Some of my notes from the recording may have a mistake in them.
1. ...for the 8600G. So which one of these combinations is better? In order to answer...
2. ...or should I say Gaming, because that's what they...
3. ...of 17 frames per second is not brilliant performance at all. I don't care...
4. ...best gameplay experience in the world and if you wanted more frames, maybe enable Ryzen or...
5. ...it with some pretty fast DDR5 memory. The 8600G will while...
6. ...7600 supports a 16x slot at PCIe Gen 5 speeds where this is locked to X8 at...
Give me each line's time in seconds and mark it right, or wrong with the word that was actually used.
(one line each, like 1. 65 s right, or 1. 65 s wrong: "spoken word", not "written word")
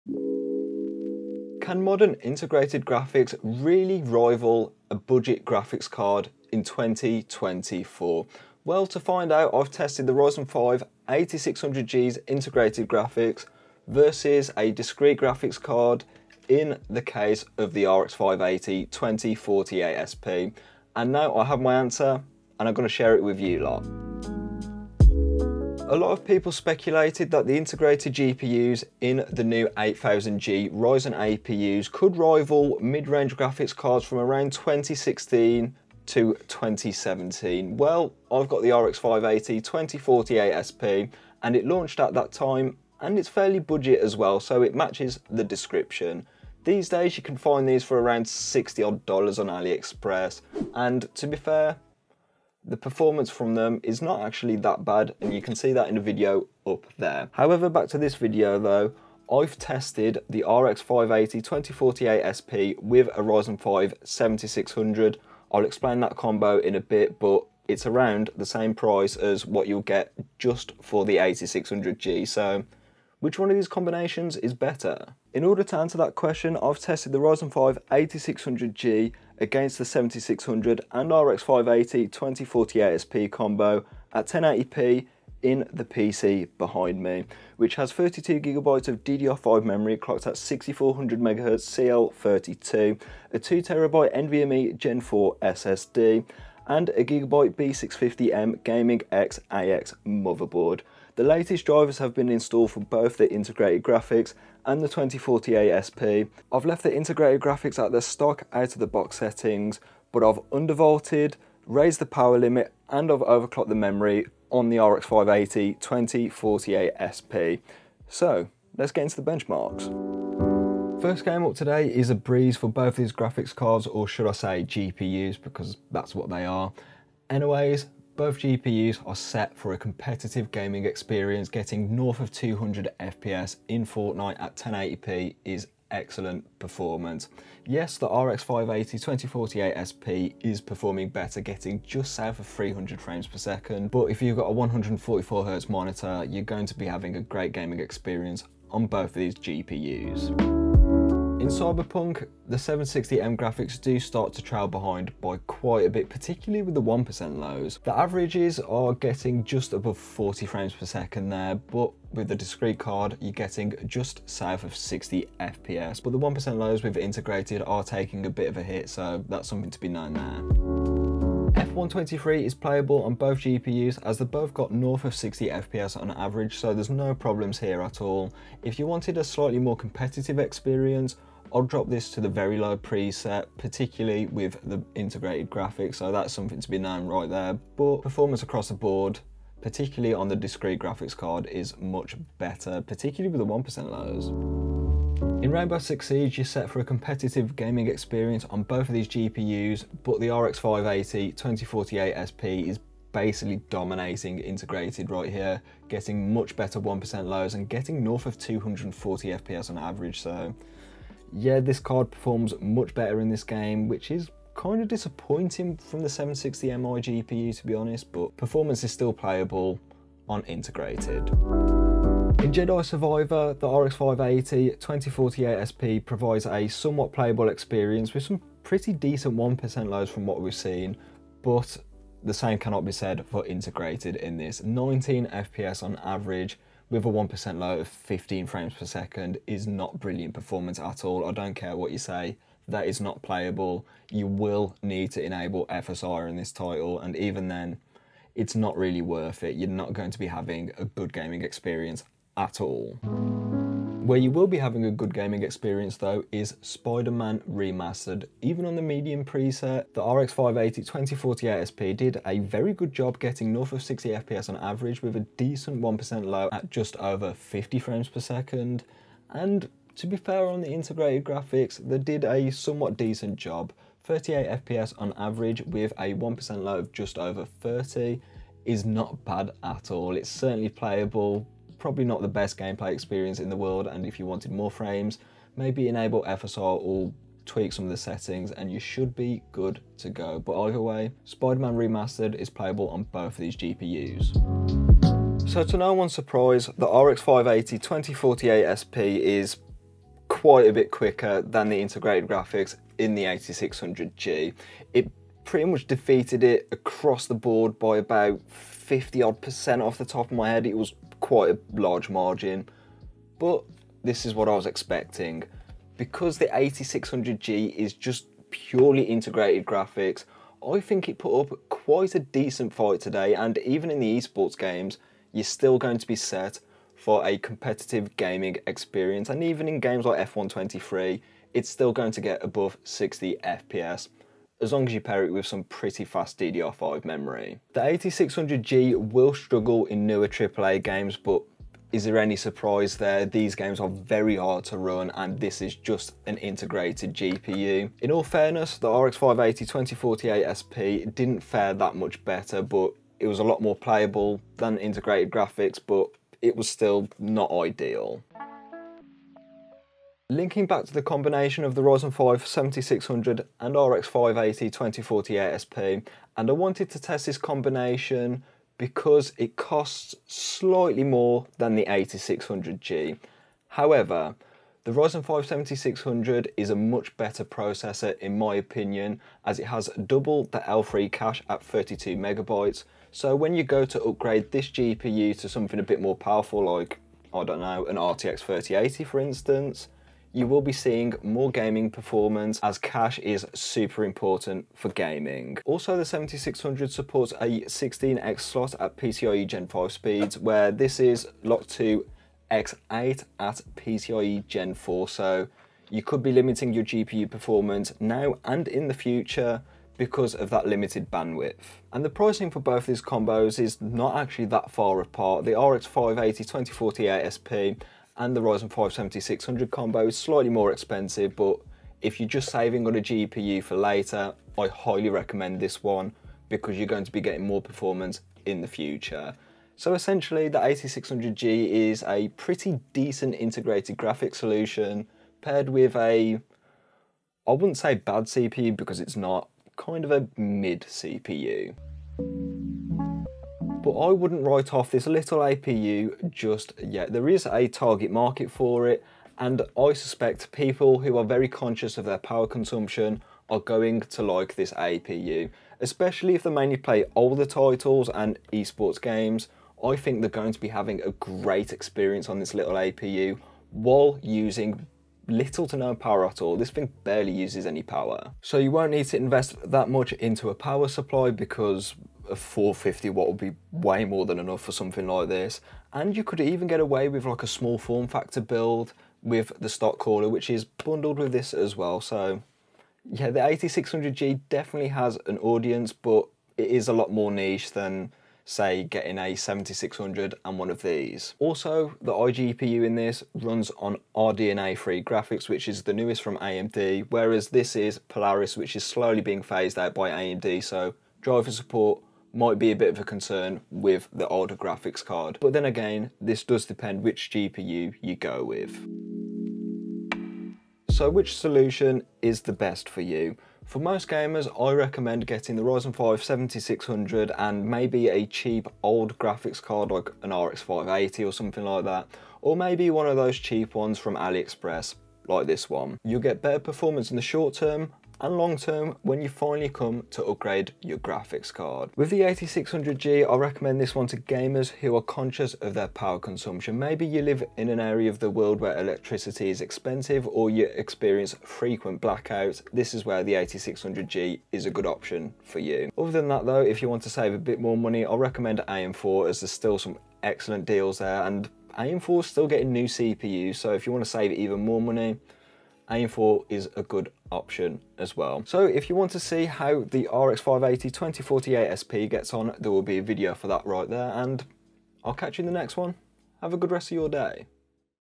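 1. 70 s right
2. 123 s wrong: "GPUs", not "Gaming"
3. 237 s wrong: "15", not "17"
4. 282 s wrong: "FSR", not "Ryzen"
5. 335 s wrong: "struggle", not "while"
6. 396 s right.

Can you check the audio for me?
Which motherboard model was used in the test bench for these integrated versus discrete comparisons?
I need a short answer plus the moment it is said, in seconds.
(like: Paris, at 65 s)
Gigabyte B650M Gaming X AX, at 97 s.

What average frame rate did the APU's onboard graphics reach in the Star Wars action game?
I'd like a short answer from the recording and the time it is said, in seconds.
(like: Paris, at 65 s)
19 FPS, at 234 s.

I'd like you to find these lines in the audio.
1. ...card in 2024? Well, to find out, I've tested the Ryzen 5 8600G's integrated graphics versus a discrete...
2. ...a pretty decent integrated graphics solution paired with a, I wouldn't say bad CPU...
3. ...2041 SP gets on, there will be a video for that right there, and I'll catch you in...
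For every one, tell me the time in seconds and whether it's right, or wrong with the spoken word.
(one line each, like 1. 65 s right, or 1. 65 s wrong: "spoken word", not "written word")
1. 5 s right
2. 432 s right
3. 560 s wrong: "2048", not "2041".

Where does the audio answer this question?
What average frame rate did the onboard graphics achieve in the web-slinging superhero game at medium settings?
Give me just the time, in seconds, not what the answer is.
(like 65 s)
274 s.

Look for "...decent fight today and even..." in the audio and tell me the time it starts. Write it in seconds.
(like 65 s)
322 s.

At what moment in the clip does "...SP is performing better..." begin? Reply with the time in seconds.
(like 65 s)
139 s.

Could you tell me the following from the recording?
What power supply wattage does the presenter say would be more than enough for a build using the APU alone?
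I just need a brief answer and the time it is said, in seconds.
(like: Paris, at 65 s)
450 watt, at 472 s.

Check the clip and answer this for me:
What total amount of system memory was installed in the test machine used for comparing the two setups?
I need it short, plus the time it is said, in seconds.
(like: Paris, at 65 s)
32GB, at 87 s.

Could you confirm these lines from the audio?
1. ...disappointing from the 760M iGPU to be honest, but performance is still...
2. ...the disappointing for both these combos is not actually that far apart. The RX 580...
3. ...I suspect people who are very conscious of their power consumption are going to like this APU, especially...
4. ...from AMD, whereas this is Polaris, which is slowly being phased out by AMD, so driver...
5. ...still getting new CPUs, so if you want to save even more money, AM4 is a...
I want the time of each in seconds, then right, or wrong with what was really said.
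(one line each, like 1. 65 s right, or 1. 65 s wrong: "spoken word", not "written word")
1. 214 s right
2. 412 s wrong: "pricing", not "disappointing"
3. 449 s right
4. 496 s right
5. 552 s right.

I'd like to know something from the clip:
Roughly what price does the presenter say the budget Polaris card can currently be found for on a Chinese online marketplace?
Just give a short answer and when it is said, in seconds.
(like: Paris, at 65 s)
$60, at 47 s.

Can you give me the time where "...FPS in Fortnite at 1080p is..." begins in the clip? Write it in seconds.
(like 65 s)
132 s.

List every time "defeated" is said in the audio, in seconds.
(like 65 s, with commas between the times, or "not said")
305 s.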